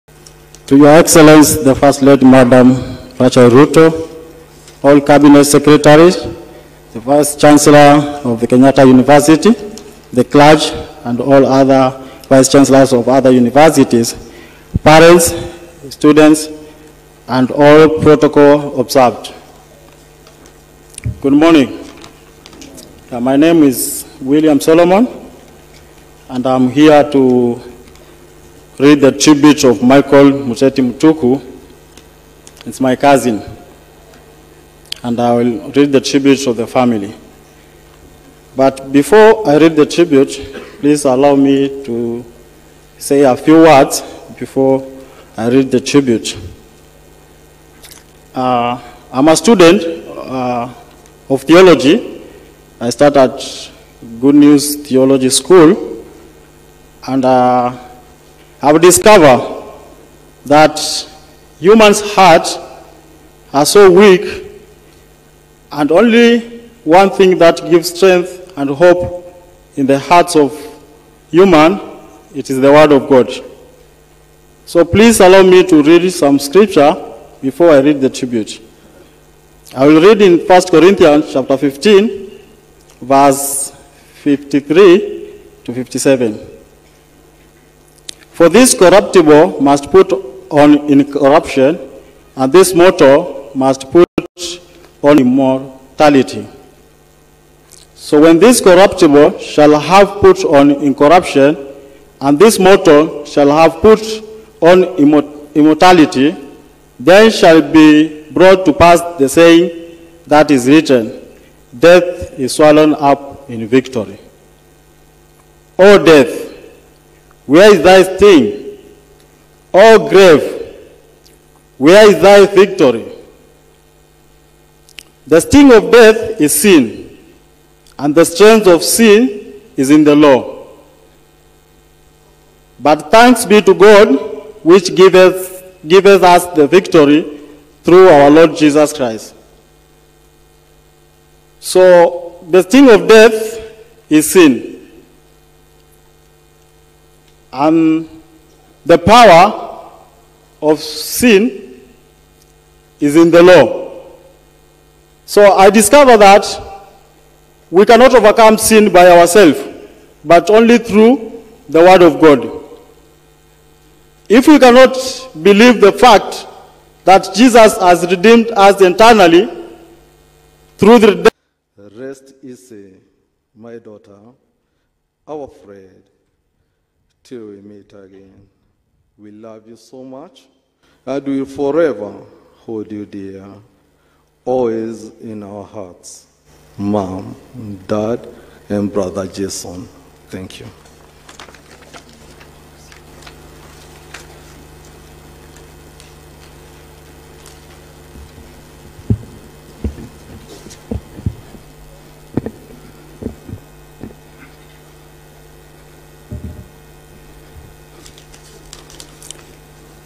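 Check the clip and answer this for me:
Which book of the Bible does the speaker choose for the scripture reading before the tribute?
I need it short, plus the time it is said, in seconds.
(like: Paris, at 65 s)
1 Corinthians, at 80 s.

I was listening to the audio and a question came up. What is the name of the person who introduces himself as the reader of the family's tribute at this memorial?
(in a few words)
William Solomon.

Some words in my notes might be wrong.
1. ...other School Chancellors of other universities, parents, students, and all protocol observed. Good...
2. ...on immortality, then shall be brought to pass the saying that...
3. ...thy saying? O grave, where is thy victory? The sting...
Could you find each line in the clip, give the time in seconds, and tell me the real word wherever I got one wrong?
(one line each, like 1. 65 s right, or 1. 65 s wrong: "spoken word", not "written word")
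1. 11 s wrong: "Vice", not "School"
2. 104 s right
3. 117 s wrong: "sting", not "saying".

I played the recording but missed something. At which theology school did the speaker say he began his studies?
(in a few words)
Good News Theology School.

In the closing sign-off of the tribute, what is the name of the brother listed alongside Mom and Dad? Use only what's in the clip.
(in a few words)
Jason.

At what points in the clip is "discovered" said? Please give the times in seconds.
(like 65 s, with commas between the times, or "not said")
58 s, 155 s.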